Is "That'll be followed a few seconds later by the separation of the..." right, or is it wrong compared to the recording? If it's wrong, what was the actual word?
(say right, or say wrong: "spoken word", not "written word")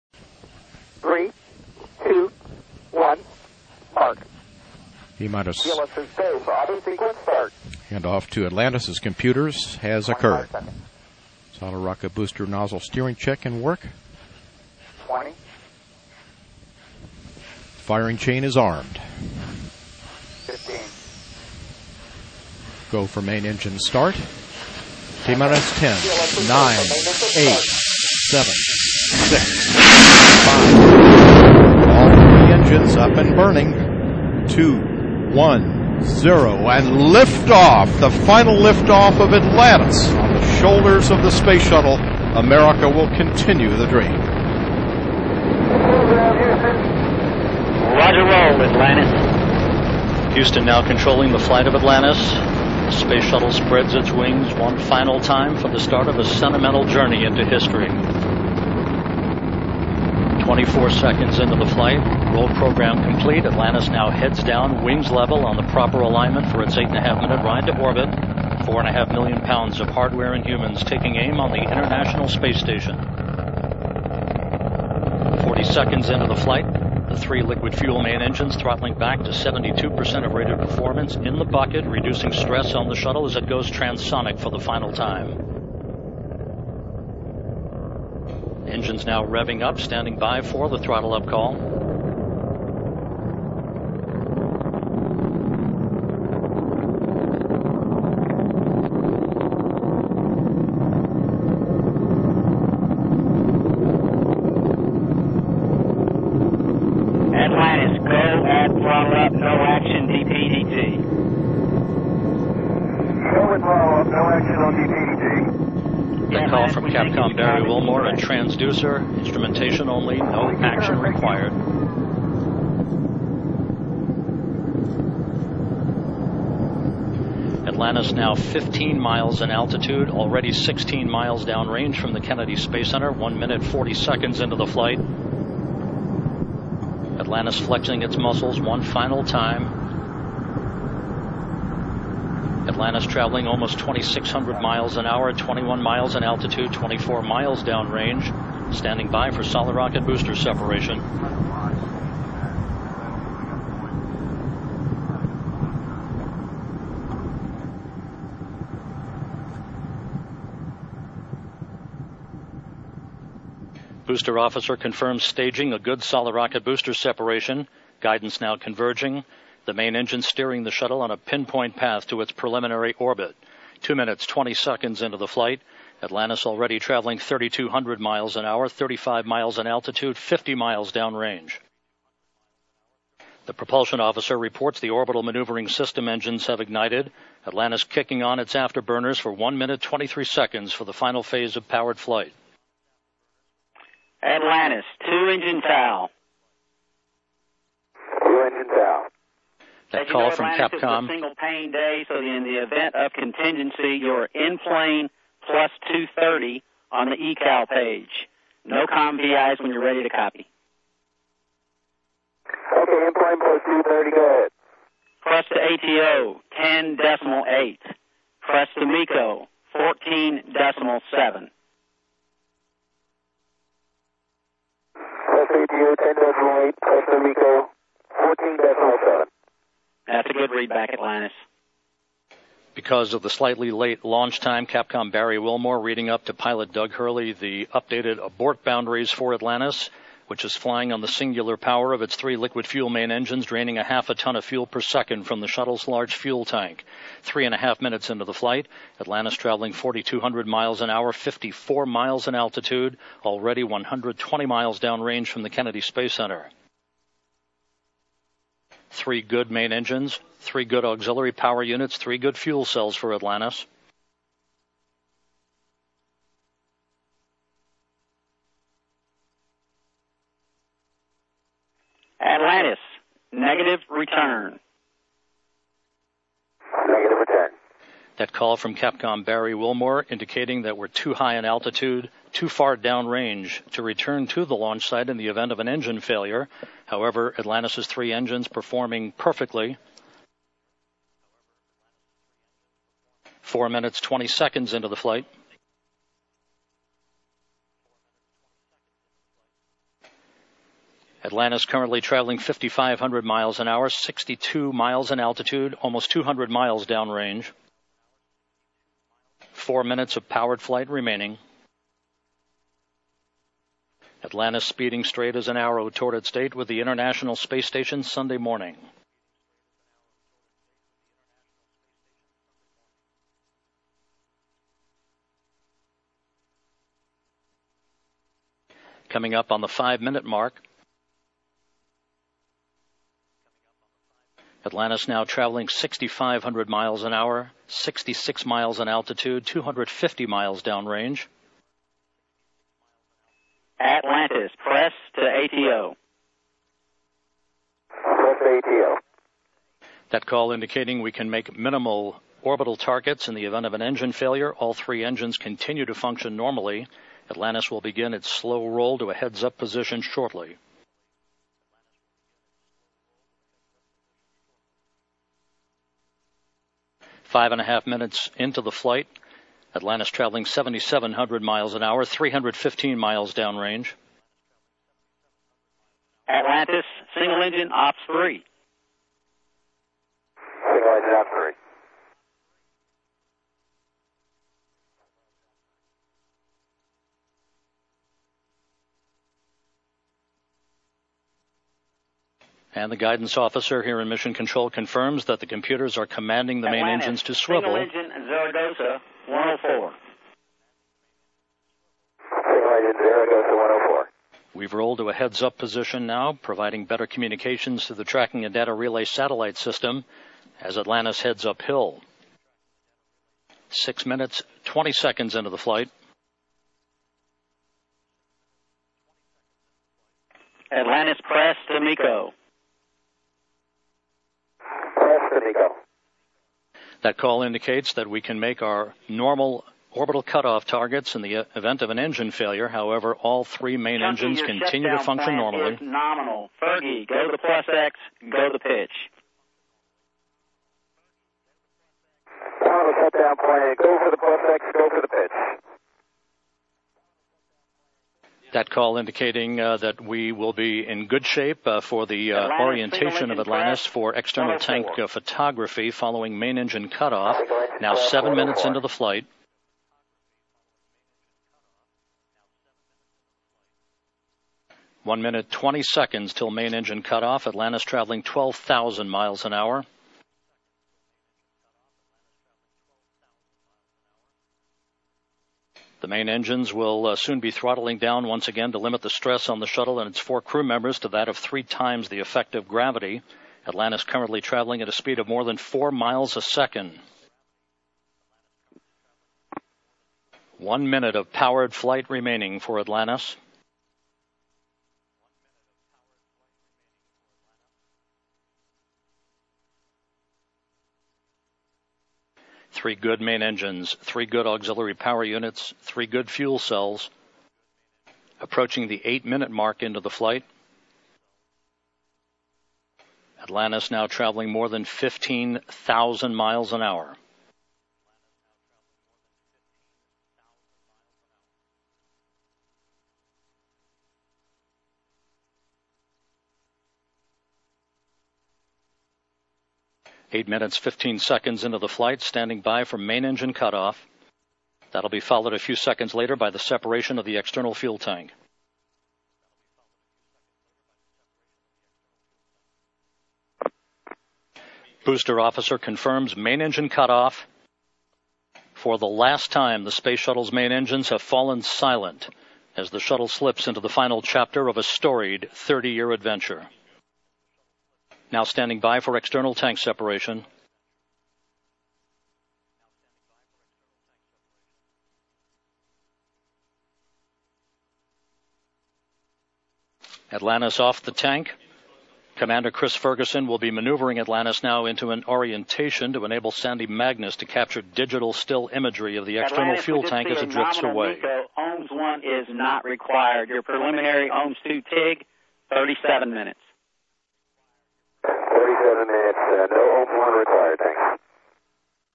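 right.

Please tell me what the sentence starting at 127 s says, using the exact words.
Atlantis now 15 miles in altitude, already 16 miles downrange from the Kennedy Space Center, 1 minute 40 seconds into the flight.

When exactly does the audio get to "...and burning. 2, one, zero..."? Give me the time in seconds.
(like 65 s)
33 s.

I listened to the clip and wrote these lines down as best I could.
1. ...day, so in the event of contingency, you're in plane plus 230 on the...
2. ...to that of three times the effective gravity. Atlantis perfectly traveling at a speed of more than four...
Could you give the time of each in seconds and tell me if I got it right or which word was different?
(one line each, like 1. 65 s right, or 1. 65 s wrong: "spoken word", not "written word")
1. 201 s right
2. 480 s wrong: "currently", not "perfectly".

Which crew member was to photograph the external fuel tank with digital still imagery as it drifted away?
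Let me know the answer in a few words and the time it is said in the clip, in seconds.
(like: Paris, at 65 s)
Sandy Magnus, at 576 s.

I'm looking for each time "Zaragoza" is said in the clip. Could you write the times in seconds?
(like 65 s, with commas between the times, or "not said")
398 s, 403 s.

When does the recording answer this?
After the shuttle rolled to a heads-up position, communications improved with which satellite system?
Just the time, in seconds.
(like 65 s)
408 s.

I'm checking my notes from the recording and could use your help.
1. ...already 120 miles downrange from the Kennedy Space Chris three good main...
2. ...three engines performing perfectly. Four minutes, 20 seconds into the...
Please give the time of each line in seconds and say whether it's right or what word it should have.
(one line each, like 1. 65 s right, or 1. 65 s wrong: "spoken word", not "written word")
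1. 253 s wrong: "Center", not "Chris"
2. 287 s right.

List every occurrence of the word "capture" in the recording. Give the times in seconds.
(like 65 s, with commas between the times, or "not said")
577 s.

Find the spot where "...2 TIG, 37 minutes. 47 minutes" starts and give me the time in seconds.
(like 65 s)
584 s.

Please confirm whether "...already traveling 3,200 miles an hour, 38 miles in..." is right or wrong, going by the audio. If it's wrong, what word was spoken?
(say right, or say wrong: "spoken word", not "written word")
wrong: "35", not "38".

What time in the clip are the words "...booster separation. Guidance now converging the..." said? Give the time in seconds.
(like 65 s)
166 s.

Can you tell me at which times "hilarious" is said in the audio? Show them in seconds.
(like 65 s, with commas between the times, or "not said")
not said.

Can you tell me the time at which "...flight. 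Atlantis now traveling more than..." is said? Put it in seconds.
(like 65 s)
510 s.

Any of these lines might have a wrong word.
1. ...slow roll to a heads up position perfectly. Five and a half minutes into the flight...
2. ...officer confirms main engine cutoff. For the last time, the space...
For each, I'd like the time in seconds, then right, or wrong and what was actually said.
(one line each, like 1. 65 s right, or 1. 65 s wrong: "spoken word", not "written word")
1. 358 s wrong: "shortly", not "perfectly"
2. 545 s right.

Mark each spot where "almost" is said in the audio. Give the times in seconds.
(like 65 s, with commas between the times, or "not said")
143 s, 305 s.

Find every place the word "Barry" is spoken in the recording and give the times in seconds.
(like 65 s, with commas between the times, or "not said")
117 s, 235 s, 279 s.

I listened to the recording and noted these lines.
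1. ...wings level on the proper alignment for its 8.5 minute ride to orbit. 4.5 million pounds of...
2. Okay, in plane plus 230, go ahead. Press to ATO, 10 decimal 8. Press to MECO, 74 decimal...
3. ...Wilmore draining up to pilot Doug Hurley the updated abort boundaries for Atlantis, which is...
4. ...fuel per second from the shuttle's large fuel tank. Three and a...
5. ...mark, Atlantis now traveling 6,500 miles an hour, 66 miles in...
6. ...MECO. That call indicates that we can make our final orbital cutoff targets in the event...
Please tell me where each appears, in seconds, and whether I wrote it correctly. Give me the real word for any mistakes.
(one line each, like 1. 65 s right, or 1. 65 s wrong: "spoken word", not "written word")
1. 64 s right
2. 212 s wrong: "14", not "74"
3. 235 s wrong: "reading", not "draining"
4. 244 s right
5. 330 s right
6. 421 s wrong: "normal", not "final".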